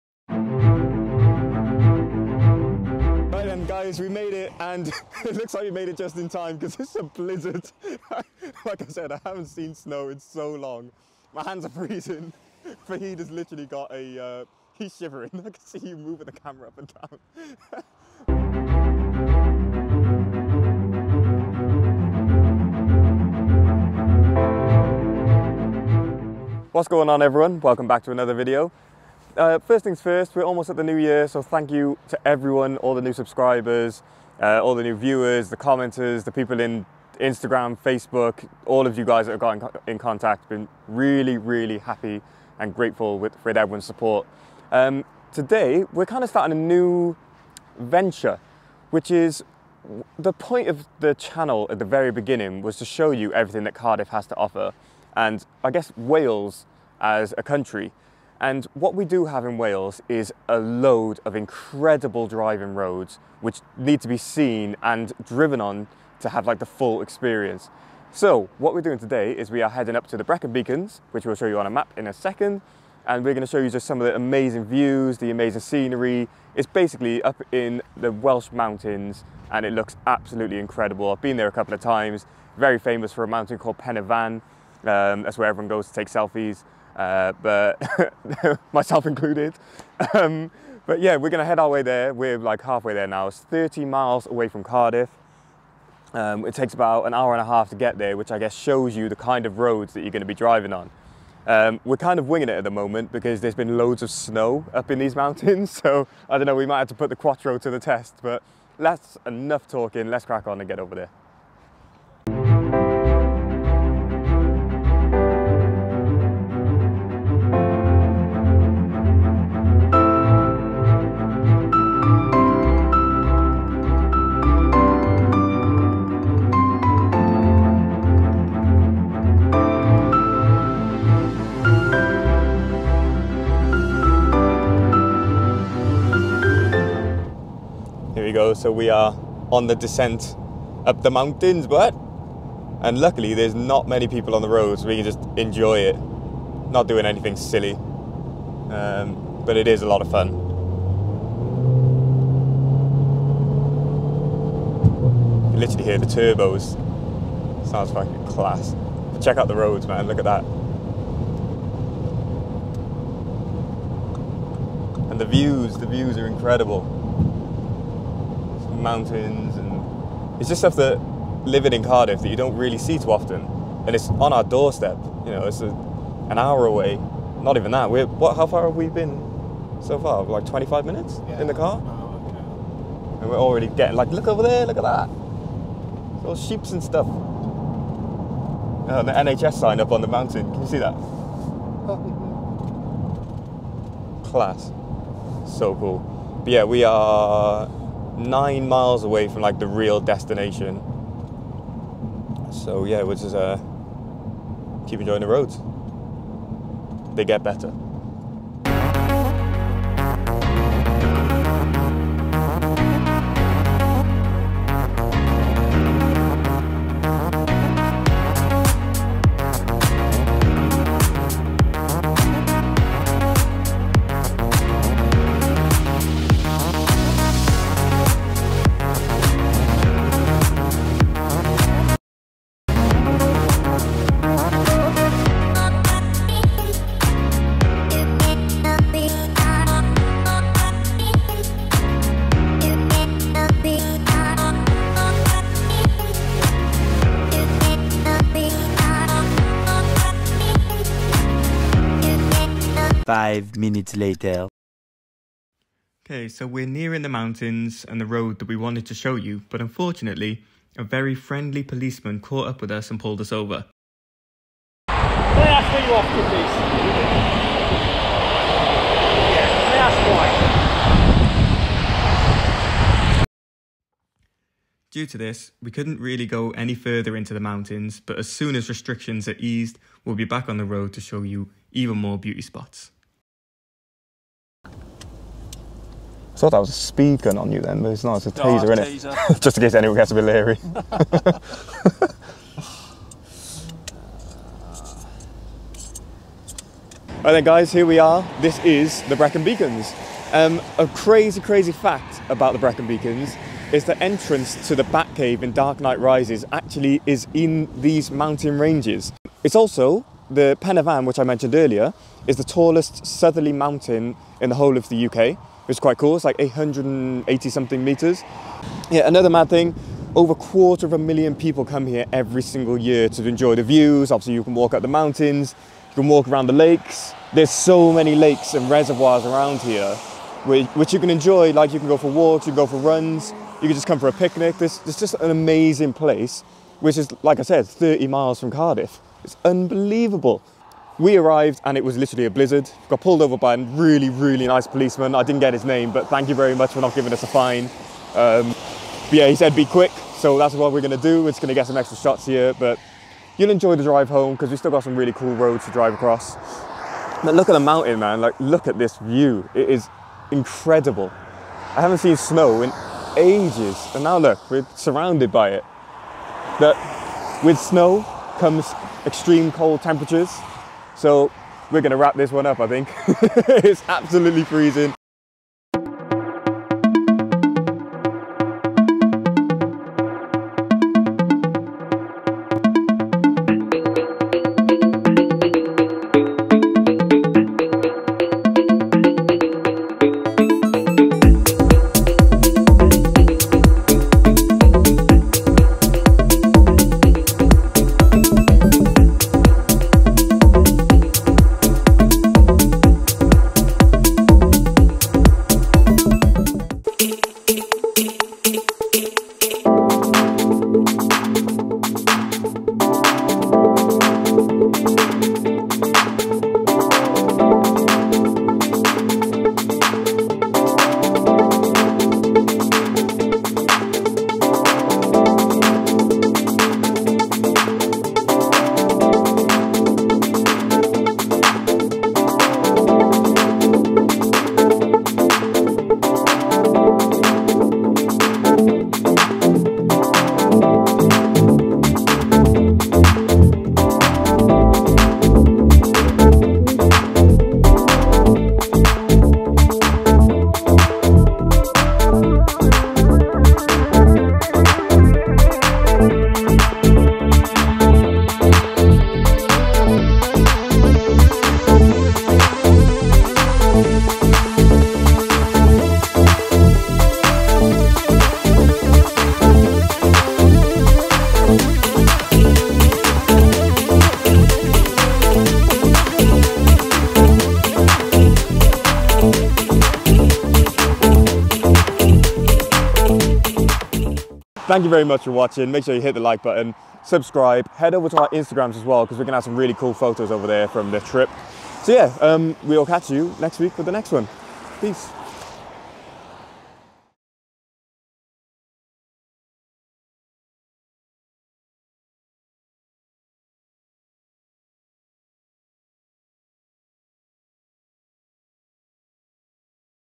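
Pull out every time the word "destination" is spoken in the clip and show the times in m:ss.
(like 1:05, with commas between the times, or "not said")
3:19.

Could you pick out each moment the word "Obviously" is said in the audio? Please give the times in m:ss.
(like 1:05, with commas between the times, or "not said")
5:24.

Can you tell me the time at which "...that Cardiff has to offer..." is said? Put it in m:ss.
0:53.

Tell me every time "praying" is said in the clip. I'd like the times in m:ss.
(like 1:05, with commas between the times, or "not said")
not said.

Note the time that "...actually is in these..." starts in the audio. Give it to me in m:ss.
5:06.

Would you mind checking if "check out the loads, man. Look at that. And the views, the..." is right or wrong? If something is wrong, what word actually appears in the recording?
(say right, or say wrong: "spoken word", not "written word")
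wrong: "roads", not "loads".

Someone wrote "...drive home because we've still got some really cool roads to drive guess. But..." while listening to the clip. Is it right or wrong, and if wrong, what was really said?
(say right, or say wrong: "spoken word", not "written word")
wrong: "across", not "guess".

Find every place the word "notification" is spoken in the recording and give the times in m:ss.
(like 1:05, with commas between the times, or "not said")
not said.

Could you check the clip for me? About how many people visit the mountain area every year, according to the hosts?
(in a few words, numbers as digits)
over a quarter of a million.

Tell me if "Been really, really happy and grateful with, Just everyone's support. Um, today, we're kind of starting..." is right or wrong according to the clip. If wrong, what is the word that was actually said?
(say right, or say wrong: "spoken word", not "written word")
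wrong: "Fred", not "Just".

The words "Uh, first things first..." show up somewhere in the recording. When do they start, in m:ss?
0:29.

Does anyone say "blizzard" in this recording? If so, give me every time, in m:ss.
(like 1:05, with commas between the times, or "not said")
0:07, 5:42.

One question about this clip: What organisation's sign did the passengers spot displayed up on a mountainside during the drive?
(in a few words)
NHS.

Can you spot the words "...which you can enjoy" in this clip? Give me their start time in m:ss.
5:30.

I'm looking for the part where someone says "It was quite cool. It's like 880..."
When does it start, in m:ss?
5:15.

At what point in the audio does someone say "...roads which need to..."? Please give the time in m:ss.
1:02.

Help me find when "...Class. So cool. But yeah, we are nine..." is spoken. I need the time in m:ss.
3:14.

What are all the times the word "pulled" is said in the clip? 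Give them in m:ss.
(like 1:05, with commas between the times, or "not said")
4:23, 5:43.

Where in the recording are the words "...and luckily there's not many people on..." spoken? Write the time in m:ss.
2:22.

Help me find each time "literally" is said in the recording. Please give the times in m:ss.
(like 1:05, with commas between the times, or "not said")
0:13, 2:35, 5:41.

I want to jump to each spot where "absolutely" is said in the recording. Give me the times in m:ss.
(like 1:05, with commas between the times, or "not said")
1:20, 6:13.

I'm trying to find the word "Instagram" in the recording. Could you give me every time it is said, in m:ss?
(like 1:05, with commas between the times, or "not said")
0:37, 8:08.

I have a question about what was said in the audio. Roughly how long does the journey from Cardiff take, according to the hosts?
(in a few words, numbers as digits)
an hour and a half.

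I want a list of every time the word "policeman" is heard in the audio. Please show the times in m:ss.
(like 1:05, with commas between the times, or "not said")
4:21, 5:44.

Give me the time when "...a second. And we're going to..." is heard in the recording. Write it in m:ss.
1:12.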